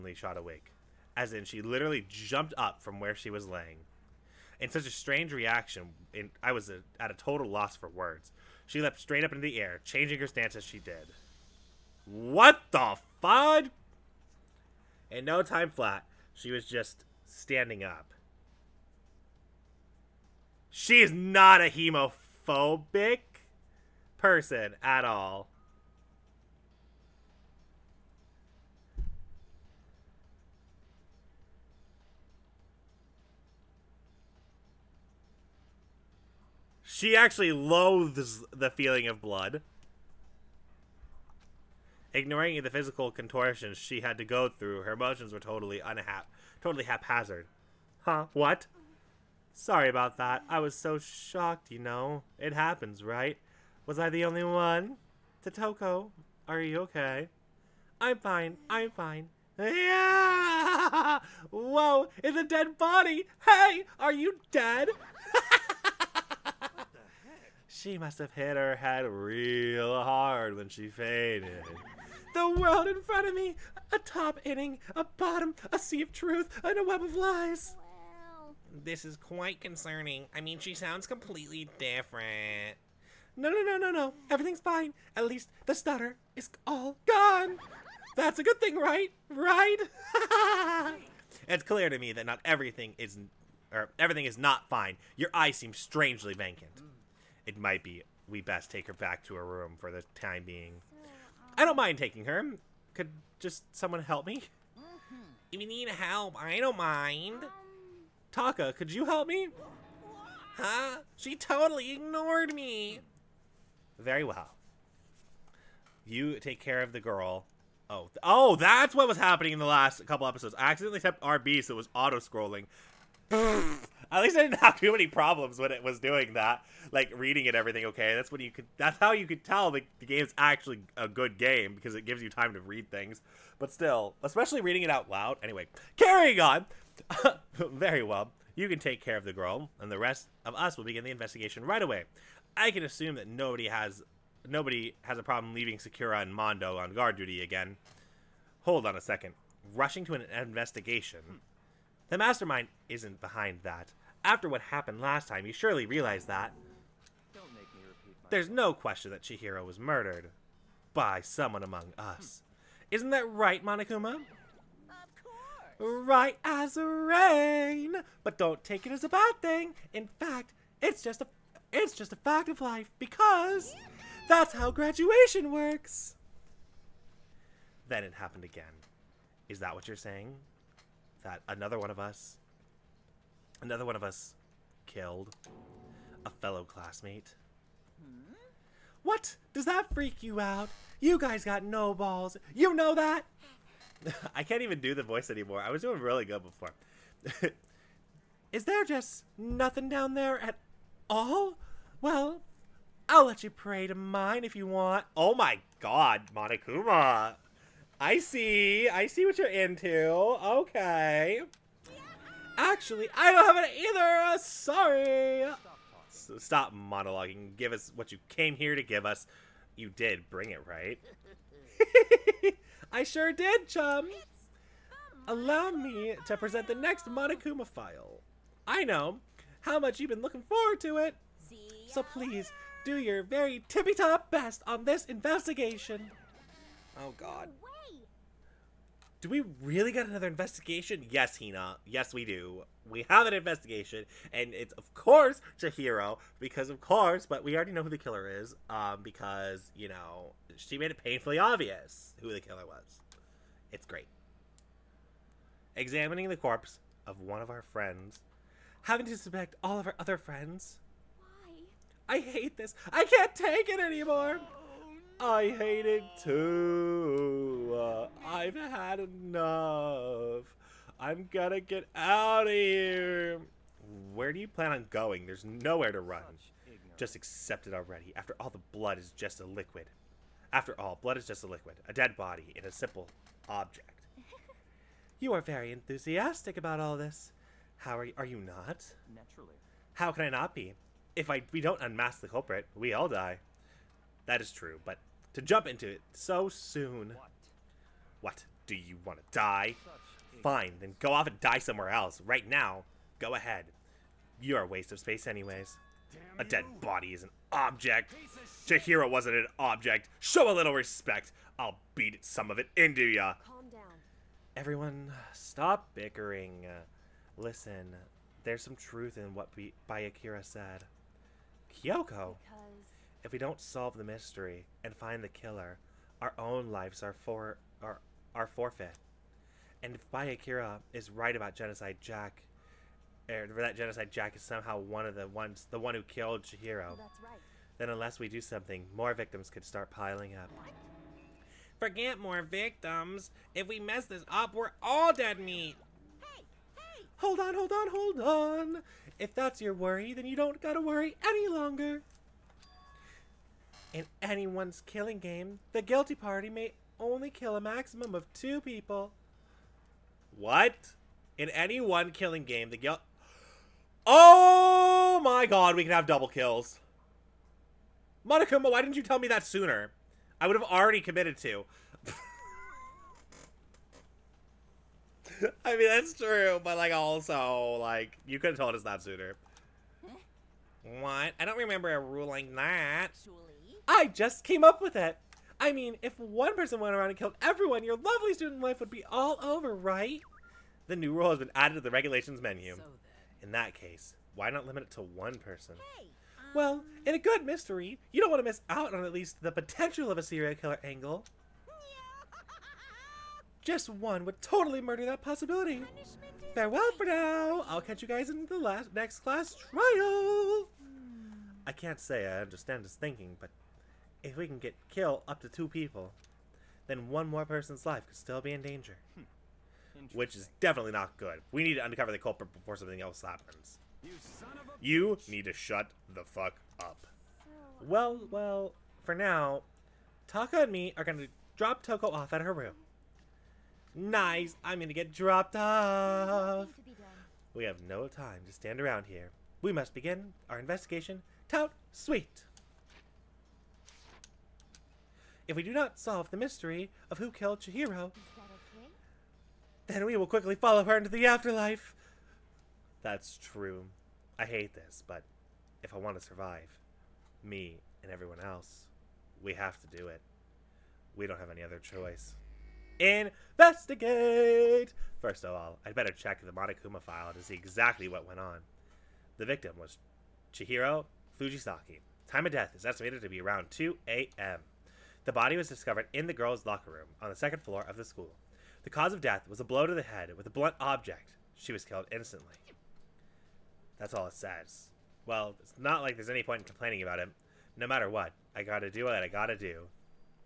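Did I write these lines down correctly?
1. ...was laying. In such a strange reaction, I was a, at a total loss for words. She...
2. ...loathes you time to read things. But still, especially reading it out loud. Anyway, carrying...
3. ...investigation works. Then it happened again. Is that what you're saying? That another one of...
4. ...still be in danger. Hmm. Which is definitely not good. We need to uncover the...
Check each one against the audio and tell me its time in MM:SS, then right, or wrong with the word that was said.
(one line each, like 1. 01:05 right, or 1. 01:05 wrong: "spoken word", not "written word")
1. 00:03 right
2. 02:12 wrong: "gives", not "loathes"
3. 02:54 wrong: "graduation", not "investigation"
4. 06:58 right.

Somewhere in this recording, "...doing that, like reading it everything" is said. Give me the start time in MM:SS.
02:06.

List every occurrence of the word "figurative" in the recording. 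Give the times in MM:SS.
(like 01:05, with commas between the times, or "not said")
not said.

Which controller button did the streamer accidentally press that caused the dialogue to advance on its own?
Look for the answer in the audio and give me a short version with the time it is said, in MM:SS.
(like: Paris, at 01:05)
RB, at 02:01.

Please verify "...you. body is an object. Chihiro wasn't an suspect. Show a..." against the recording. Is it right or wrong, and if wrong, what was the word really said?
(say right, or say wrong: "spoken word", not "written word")
wrong: "object", not "suspect".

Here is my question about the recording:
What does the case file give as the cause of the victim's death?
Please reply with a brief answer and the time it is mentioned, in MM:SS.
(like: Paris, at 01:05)
Blow to the head, at 07:59.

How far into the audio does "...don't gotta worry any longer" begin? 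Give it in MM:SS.
05:50.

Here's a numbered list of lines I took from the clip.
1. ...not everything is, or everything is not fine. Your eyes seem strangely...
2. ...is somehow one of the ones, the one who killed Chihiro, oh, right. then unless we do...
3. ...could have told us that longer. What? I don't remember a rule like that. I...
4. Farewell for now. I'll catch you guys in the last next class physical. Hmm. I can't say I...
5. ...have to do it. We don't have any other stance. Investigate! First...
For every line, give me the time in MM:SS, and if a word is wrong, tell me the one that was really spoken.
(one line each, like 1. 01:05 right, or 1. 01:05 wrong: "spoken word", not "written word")
1. 01:32 right
2. 05:34 right
3. 06:18 wrong: "sooner", not "longer"
4. 06:46 wrong: "trial", not "physical"
5. 07:39 wrong: "choice", not "stance".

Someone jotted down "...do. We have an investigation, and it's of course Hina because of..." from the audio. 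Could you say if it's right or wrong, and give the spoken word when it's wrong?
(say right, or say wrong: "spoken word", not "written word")
wrong: "Chihiro", not "Hina".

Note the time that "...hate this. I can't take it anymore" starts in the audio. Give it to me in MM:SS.
04:22.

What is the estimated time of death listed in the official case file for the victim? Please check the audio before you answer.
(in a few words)
2 a.m.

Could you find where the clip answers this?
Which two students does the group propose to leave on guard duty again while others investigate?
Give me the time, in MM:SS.
02:25.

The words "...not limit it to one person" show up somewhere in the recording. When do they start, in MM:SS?
06:34.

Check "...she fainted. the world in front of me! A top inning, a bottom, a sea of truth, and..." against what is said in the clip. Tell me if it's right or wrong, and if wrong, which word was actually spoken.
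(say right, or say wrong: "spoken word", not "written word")
right.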